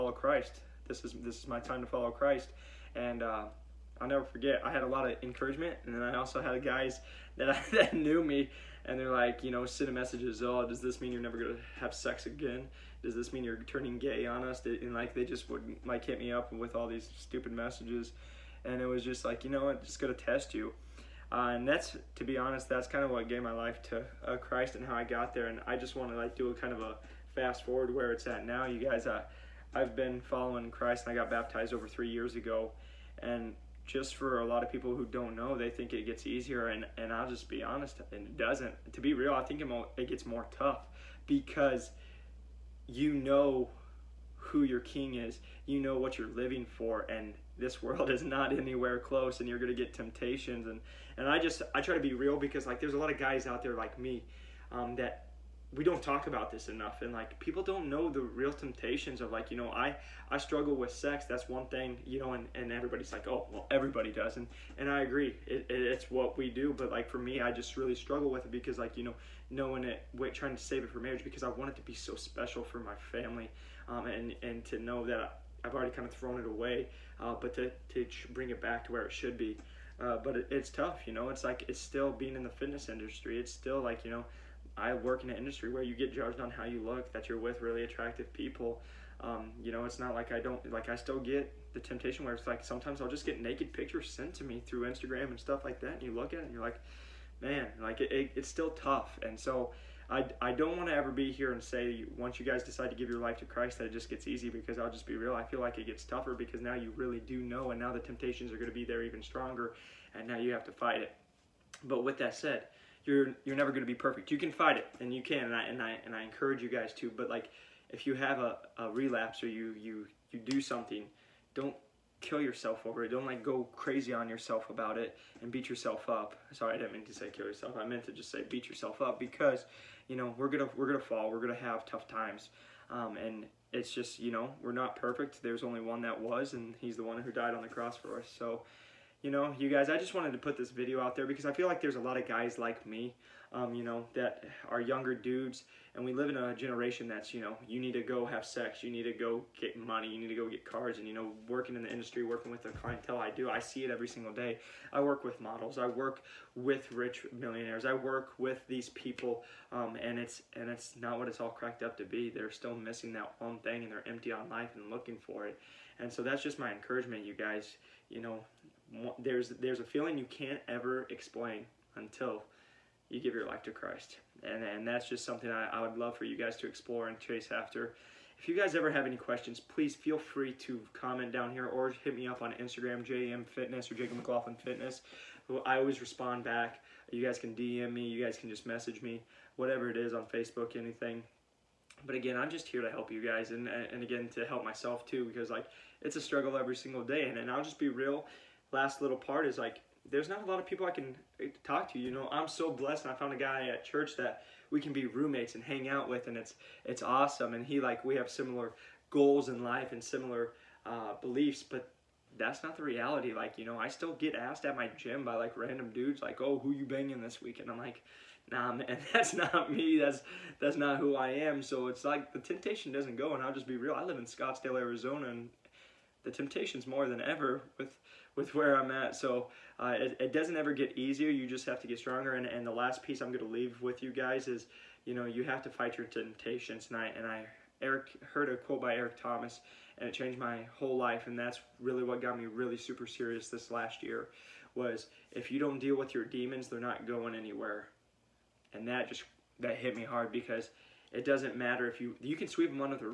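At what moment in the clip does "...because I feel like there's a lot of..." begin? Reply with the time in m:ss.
2:21.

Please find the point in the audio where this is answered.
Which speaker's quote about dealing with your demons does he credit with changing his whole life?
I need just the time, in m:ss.
3:58.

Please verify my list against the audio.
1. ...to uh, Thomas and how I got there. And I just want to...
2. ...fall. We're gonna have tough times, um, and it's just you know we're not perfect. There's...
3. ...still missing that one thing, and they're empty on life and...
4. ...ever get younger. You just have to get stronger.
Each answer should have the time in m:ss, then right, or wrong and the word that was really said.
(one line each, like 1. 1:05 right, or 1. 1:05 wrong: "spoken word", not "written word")
1. 0:23 wrong: "Christ", not "Thomas"
2. 2:10 right
3. 2:42 right
4. 3:50 wrong: "easier", not "younger".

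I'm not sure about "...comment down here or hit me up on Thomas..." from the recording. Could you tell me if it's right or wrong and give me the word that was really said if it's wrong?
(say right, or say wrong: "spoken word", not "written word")
wrong: "Instagram", not "Thomas".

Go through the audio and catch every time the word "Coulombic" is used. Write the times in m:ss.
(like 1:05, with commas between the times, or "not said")
not said.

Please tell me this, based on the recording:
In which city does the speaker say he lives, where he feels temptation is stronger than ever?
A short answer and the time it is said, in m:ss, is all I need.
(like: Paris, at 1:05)
Scottsdale, at 3:44.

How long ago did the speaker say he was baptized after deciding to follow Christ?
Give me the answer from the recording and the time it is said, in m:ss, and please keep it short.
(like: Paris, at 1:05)
over 3 years ago, at 0:31.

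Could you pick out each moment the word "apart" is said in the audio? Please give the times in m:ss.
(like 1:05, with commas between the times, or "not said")
not said.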